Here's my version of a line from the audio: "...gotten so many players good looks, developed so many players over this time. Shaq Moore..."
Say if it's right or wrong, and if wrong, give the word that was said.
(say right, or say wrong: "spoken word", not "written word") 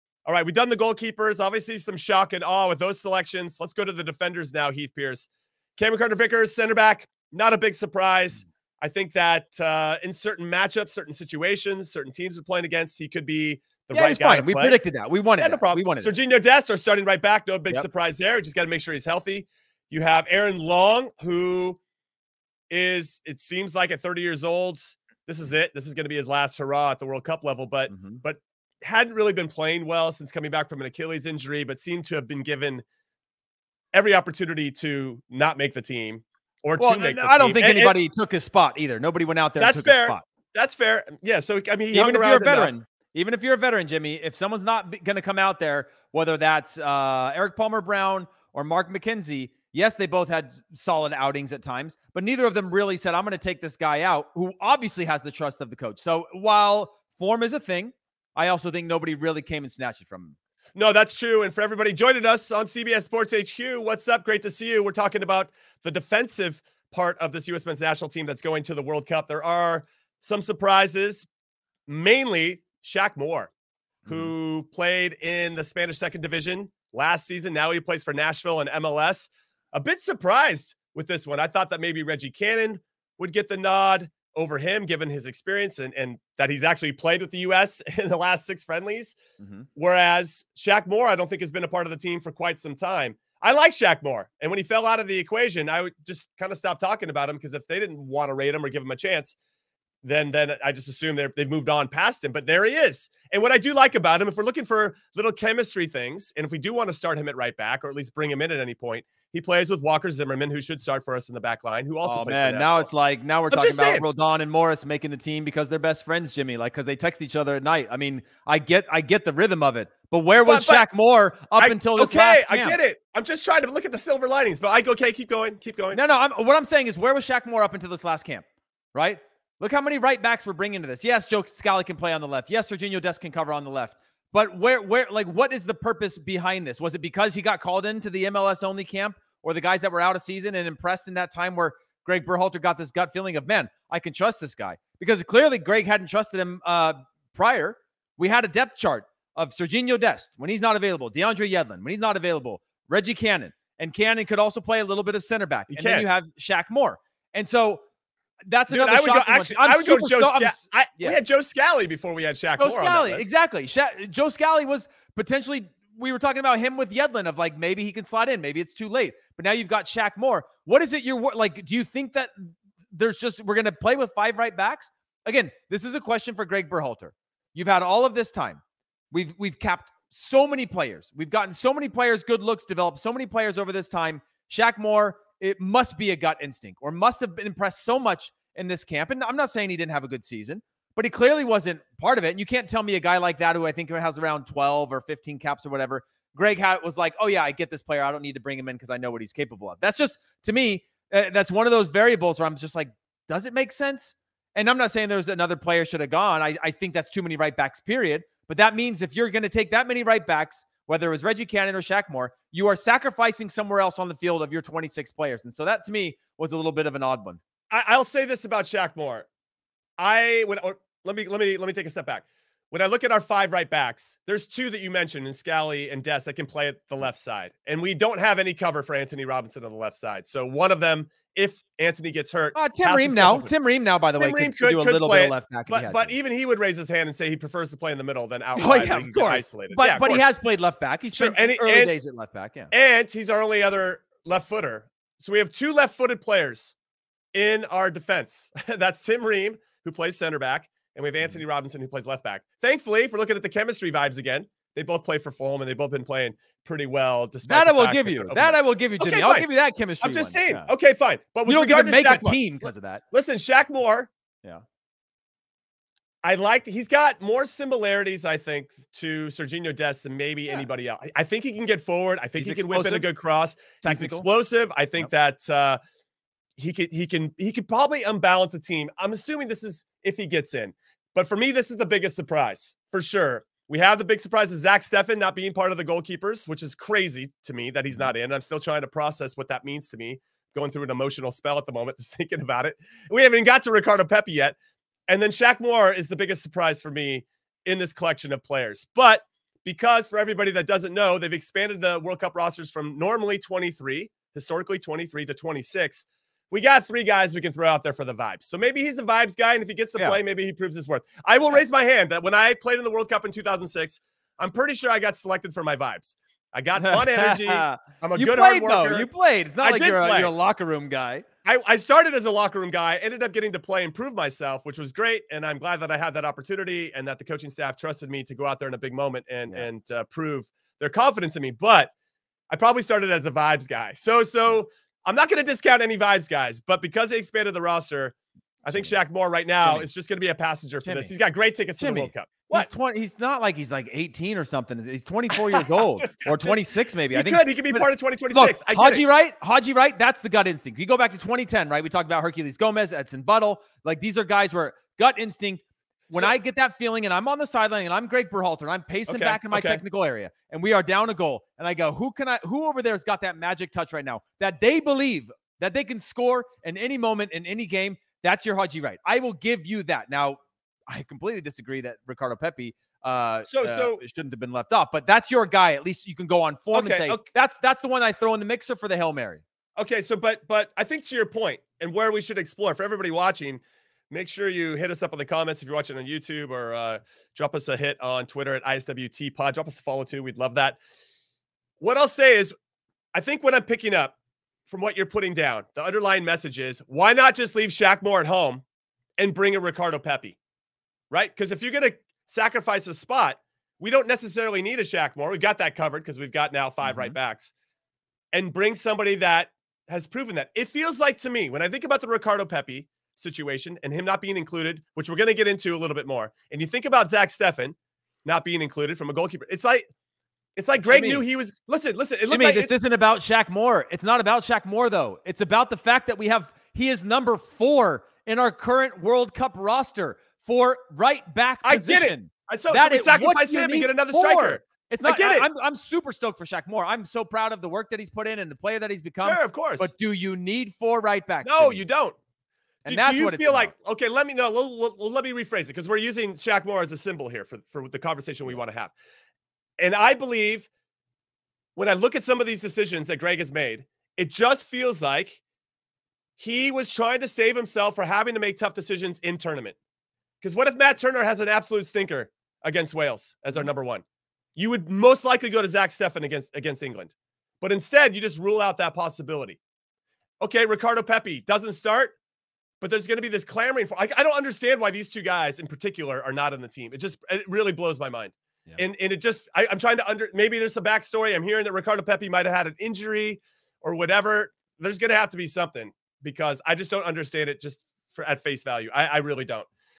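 right.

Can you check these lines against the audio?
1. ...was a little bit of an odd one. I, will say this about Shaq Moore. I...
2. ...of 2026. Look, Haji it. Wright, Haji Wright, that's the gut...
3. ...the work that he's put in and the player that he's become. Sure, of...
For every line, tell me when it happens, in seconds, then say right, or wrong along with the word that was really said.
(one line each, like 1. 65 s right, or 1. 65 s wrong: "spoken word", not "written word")
1. 216 s right
2. 347 s right
3. 437 s right.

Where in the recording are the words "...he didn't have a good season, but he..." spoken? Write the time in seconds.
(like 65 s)
189 s.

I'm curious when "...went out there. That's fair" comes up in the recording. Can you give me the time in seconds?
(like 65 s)
39 s.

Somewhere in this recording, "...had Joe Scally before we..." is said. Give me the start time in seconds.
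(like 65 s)
161 s.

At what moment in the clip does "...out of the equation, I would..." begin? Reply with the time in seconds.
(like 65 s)
94 s.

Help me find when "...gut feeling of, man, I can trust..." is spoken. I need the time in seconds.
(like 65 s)
142 s.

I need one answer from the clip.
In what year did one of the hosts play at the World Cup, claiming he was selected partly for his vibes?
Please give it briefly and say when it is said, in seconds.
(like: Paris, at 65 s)
2006, at 313 s.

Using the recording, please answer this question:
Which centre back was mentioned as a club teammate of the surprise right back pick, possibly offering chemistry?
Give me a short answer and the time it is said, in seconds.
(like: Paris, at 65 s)
Walker Zimmerman, at 109 s.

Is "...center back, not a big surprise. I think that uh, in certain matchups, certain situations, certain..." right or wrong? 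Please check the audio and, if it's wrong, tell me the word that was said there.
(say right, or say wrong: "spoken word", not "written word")
right.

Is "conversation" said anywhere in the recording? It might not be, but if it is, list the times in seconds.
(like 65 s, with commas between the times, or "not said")
447 s.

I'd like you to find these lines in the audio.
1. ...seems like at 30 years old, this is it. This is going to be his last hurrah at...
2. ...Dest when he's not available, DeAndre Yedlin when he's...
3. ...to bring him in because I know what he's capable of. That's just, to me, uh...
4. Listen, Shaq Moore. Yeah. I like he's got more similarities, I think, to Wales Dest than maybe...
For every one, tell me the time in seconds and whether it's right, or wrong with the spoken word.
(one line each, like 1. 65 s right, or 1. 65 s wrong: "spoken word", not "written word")
1. 23 s right
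2. 149 s right
3. 198 s right
4. 263 s wrong: "Serginho", not "Wales".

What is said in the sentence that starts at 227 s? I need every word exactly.
And we don't have any cover for Antonee Robinson on the left side.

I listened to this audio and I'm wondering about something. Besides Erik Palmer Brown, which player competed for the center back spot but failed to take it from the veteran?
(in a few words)
Mark McKenzie.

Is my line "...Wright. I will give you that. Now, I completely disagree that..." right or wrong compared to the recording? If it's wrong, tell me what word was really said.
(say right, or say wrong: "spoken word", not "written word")
right.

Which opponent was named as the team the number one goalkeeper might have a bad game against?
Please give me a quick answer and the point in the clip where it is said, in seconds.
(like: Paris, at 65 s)
Wales, at 462 s.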